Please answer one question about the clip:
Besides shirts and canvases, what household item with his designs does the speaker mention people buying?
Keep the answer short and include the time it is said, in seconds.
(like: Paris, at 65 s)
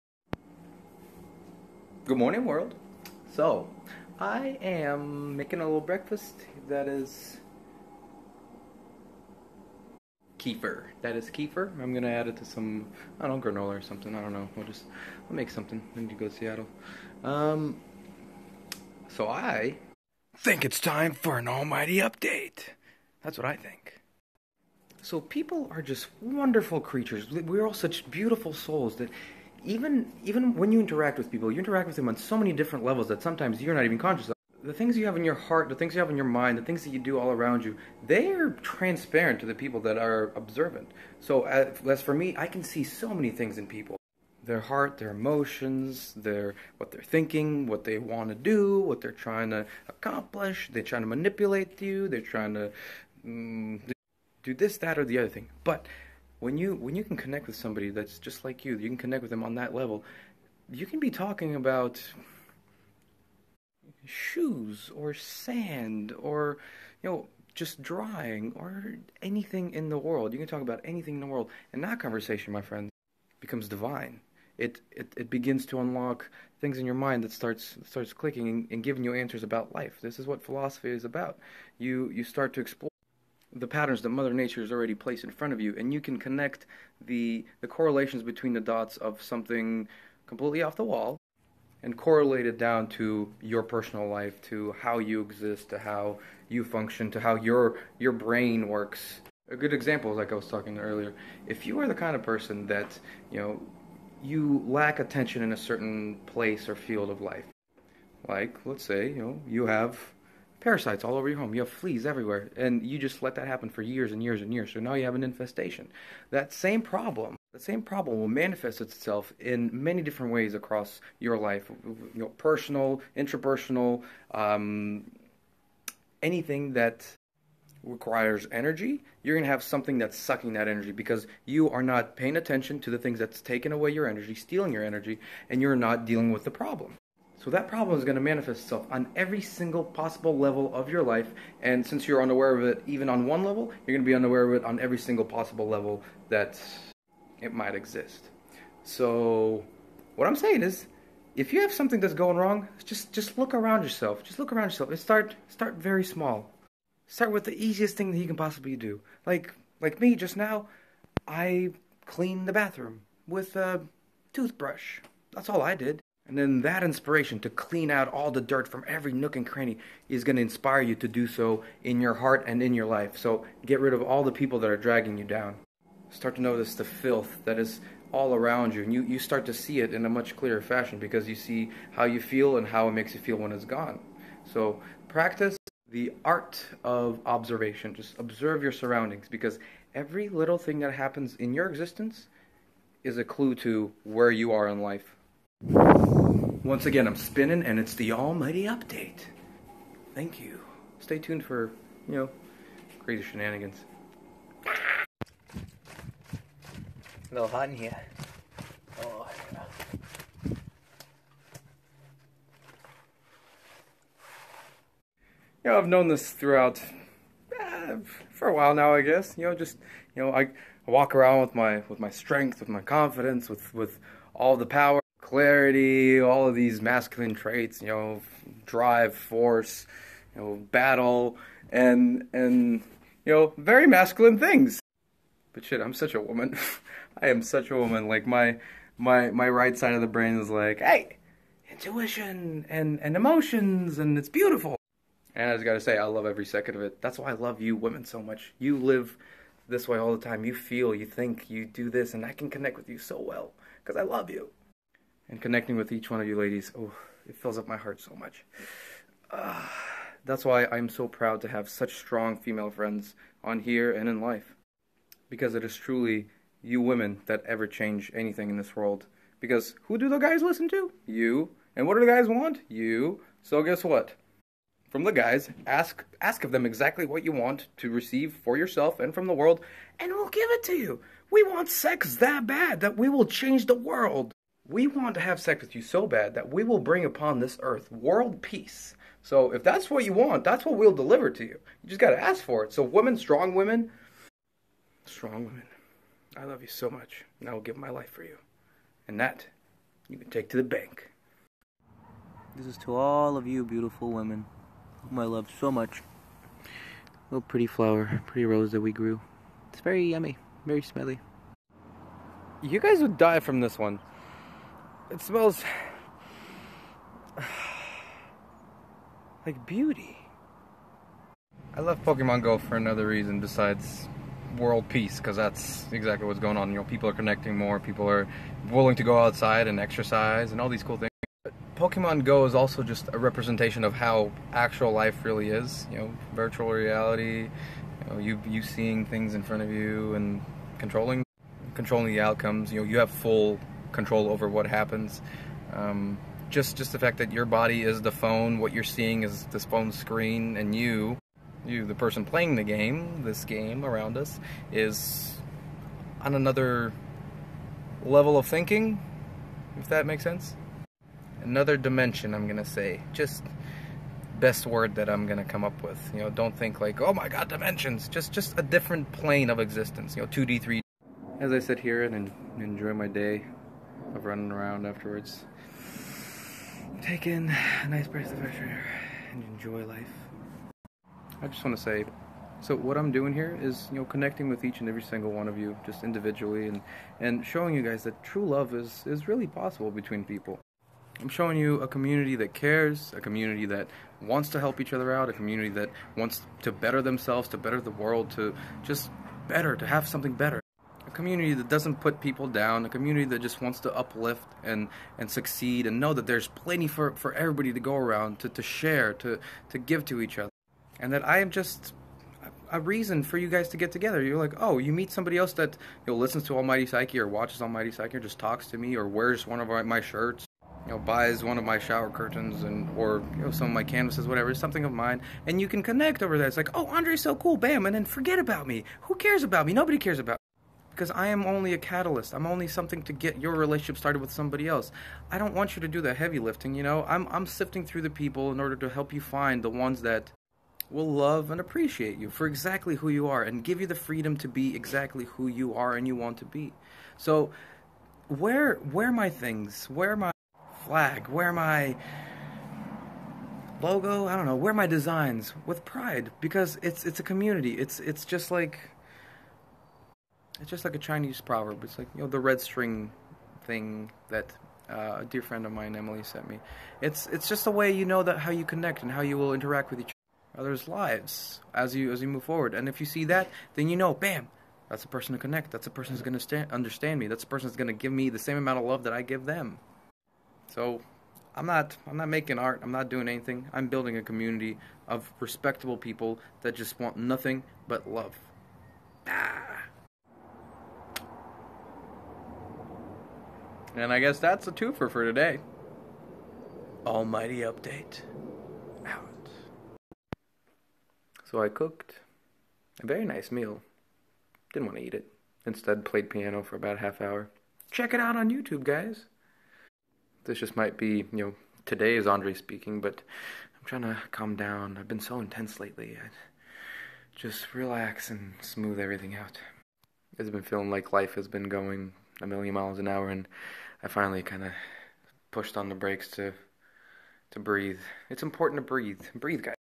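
Shower curtains, at 421 s.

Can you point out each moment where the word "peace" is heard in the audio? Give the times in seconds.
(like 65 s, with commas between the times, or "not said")
288 s, 324 s.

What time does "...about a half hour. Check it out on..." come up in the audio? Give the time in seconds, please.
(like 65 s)
506 s.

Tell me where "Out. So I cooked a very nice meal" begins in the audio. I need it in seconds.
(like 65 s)
499 s.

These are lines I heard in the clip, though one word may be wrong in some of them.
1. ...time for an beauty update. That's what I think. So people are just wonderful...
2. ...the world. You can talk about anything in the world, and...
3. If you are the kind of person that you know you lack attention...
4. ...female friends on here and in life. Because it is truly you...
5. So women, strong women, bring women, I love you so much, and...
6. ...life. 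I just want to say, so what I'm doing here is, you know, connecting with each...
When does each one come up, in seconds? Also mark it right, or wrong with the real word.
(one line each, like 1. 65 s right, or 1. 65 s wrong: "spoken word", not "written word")
1. 20 s wrong: "almighty", not "beauty"
2. 69 s right
3. 101 s right
4. 262 s right
5. 292 s wrong: "strong", not "bring"
6. 379 s right.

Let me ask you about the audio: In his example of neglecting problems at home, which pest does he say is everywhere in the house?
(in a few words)
Fleas.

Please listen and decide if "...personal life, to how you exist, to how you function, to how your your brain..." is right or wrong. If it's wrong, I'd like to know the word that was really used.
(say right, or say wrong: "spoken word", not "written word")
right.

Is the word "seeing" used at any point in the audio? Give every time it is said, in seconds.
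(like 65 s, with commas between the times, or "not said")
338 s, 348 s.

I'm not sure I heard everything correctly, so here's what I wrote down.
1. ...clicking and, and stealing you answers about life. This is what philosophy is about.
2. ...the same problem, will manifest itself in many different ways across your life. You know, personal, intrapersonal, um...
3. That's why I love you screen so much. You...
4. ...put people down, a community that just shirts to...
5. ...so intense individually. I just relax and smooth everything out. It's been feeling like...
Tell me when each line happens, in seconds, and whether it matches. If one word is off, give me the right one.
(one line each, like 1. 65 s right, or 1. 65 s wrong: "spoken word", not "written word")
1. 78 s wrong: "giving", not "stealing"
2. 117 s right
3. 247 s wrong: "women", not "screen"
4. 402 s wrong: "wants", not "shirts"
5. 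515 s wrong: "lately", not "individually".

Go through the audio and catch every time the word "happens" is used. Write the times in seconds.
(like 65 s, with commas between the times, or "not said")
113 s, 190 s, 344 s.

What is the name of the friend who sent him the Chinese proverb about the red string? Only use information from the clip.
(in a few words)
Emily.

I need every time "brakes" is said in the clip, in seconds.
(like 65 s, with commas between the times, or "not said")
525 s.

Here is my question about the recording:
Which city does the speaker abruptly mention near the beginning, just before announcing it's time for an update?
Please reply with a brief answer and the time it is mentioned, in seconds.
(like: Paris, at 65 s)
Seattle, at 16 s.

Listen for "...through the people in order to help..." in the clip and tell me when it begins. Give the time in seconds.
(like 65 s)
437 s.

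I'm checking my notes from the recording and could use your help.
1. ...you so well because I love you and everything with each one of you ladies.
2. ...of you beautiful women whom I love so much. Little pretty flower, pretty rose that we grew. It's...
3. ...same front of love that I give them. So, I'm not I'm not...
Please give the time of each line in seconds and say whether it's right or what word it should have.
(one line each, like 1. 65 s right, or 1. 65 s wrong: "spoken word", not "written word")
1. 252 s wrong: "connecting", not "everything"
2. 303 s right
3. 478 s wrong: "amount", not "front".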